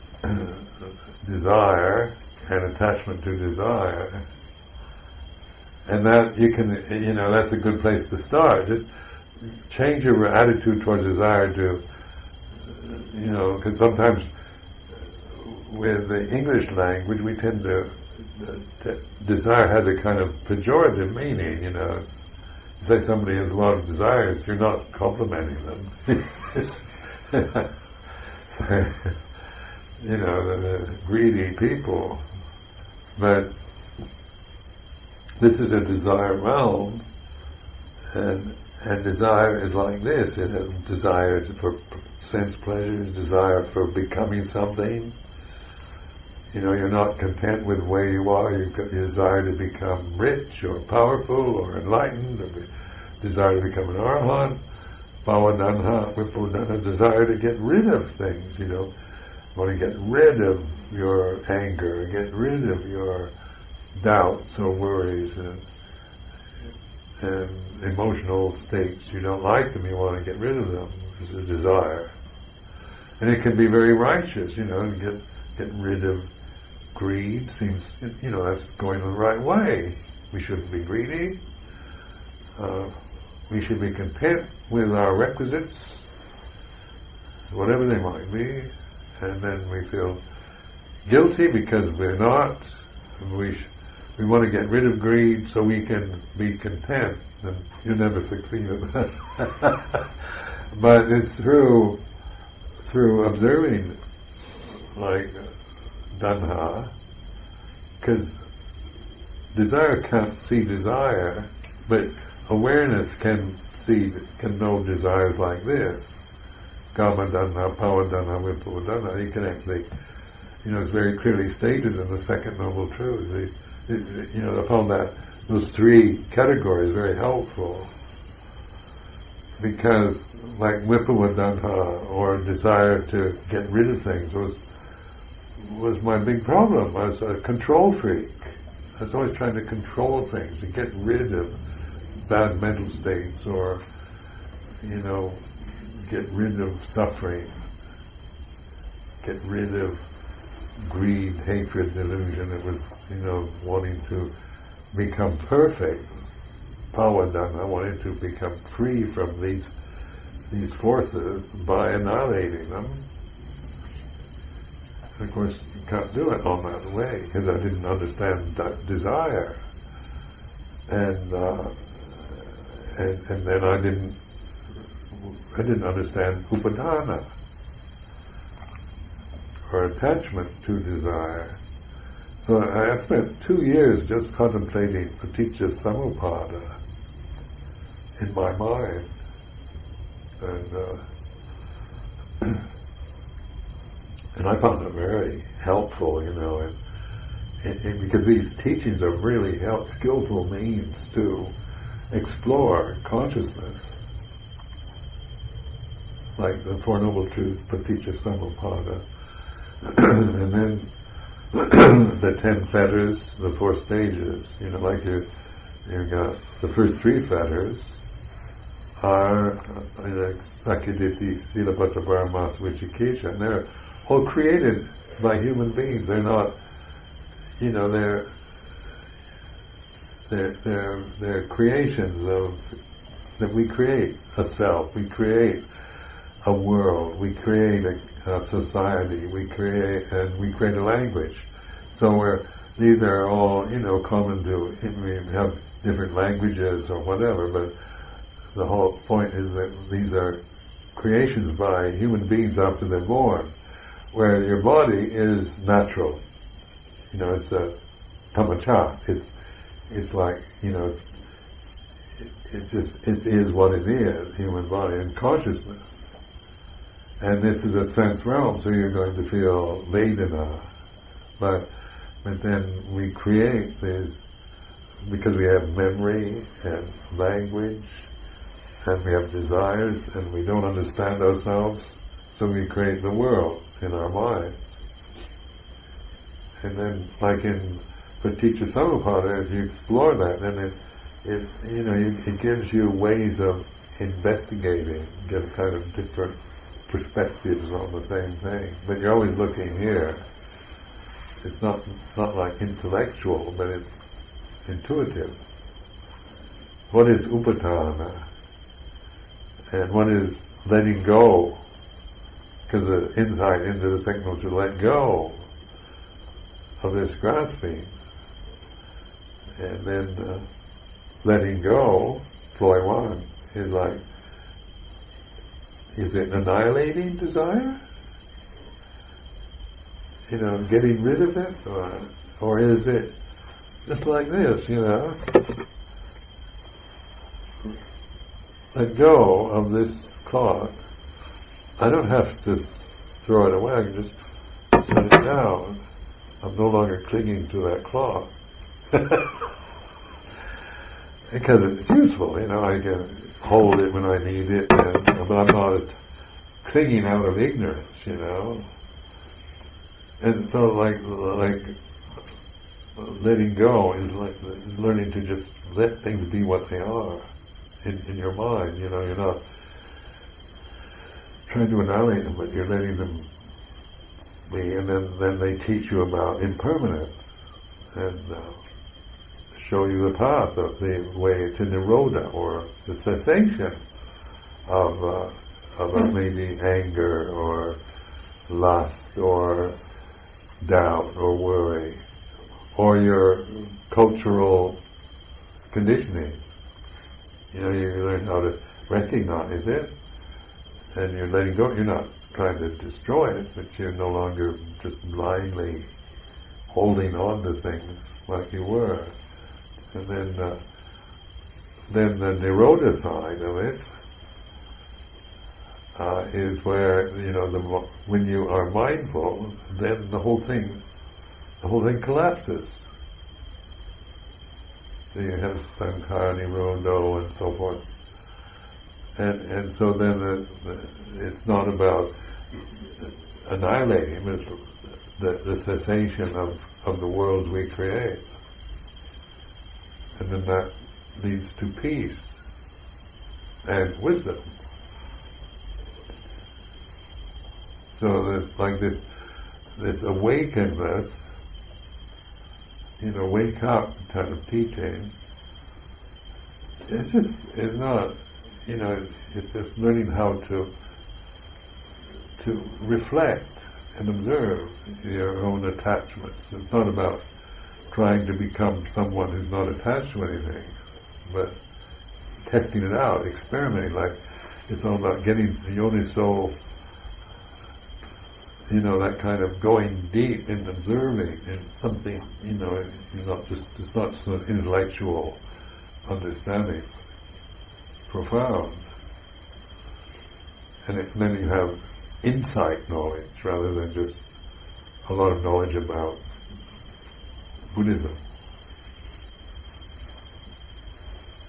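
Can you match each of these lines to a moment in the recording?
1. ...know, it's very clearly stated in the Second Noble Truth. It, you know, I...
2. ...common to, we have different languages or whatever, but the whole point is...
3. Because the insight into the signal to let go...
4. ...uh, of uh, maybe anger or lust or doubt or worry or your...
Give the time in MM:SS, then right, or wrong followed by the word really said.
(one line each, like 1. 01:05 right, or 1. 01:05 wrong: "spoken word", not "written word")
1. 02:00 right
2. 04:03 right
3. 05:12 right
4. 06:25 right.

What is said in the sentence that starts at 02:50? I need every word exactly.
And uh, and, and then I didn't I didn't understand upadana or attachment to desire.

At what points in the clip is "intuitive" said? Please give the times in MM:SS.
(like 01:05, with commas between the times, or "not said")
05:04.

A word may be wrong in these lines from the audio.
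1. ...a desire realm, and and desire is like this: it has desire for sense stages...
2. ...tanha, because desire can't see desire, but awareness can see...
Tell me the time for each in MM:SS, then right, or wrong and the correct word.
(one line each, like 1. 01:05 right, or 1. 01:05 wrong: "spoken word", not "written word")
1. 00:35 wrong: "pleasures", not "stages"
2. 01:46 right.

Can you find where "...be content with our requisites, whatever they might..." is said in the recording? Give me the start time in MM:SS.
01:23.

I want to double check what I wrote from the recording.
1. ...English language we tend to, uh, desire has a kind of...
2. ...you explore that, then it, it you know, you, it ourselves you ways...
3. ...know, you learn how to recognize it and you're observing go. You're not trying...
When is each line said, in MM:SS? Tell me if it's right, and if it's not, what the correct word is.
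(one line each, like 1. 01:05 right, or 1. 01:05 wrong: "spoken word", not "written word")
1. 00:16 right
2. 04:49 wrong: "gives", not "ourselves"
3. 06:37 wrong: "letting", not "observing".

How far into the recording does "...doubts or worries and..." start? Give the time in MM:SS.
01:04.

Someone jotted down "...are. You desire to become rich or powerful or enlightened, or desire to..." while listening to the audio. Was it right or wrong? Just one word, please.
right.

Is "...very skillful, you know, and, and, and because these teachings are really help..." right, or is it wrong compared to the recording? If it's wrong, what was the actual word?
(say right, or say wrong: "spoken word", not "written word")
wrong: "helpful", not "skillful".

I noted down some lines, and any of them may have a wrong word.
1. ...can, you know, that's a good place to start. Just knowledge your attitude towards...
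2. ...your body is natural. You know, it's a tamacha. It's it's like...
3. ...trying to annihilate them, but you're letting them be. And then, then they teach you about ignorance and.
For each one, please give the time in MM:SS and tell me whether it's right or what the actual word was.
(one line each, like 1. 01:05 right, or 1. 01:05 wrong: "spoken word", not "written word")
1. 00:06 wrong: "change", not "knowledge"
2. 04:14 right
3. 06:11 wrong: "impermanence", not "ignorance".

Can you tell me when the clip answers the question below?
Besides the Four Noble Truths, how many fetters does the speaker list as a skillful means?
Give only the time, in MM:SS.
03:32.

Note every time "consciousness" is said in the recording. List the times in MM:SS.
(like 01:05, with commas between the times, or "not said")
03:23, 04:25.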